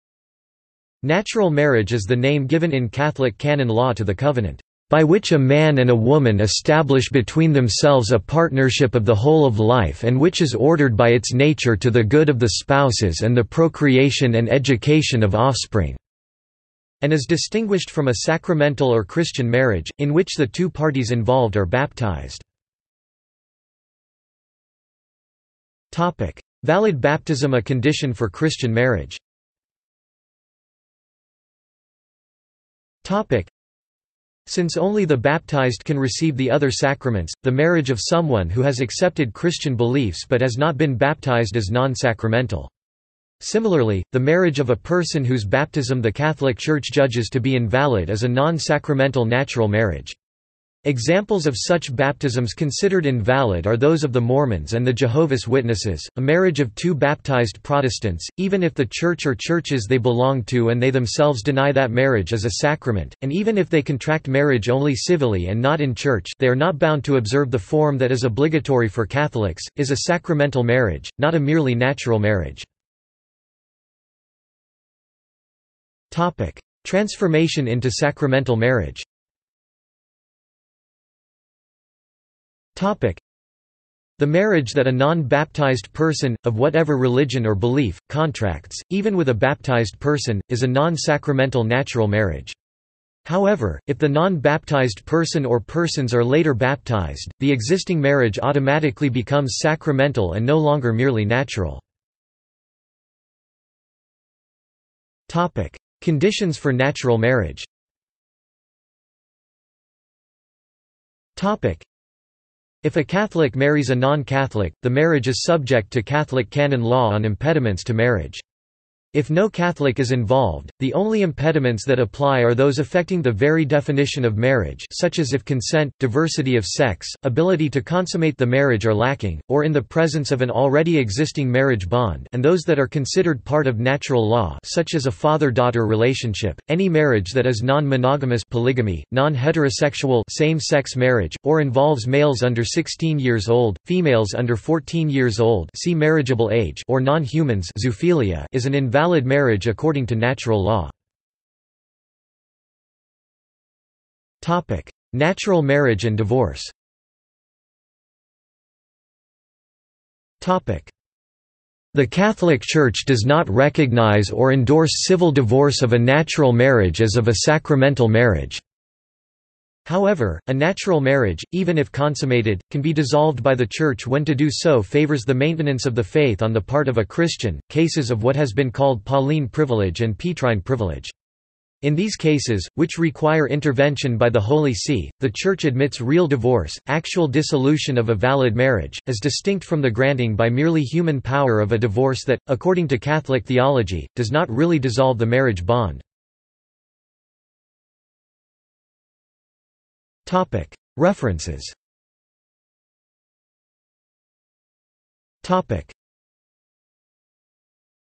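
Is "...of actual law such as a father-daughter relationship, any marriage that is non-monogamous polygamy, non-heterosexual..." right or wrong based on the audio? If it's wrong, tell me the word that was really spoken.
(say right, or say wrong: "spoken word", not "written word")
wrong: "natural", not "actual".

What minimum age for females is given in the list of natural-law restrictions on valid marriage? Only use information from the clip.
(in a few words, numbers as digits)
14.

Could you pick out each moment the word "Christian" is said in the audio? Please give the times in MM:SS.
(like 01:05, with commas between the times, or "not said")
00:19, 00:28, 00:39, 02:57.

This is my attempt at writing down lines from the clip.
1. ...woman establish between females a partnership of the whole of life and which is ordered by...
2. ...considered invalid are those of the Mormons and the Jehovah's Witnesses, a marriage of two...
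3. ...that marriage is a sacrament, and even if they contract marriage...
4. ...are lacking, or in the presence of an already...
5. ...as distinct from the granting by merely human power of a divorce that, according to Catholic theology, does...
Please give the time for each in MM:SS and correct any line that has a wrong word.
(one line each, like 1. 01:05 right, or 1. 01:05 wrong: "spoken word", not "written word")
1. 00:05 wrong: "themselves", not "females"
2. 00:52 right
3. 01:01 right
4. 02:08 right
5. 03:09 right.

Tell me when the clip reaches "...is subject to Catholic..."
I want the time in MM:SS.
01:55.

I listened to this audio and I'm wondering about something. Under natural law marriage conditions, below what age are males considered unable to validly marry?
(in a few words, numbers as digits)
16.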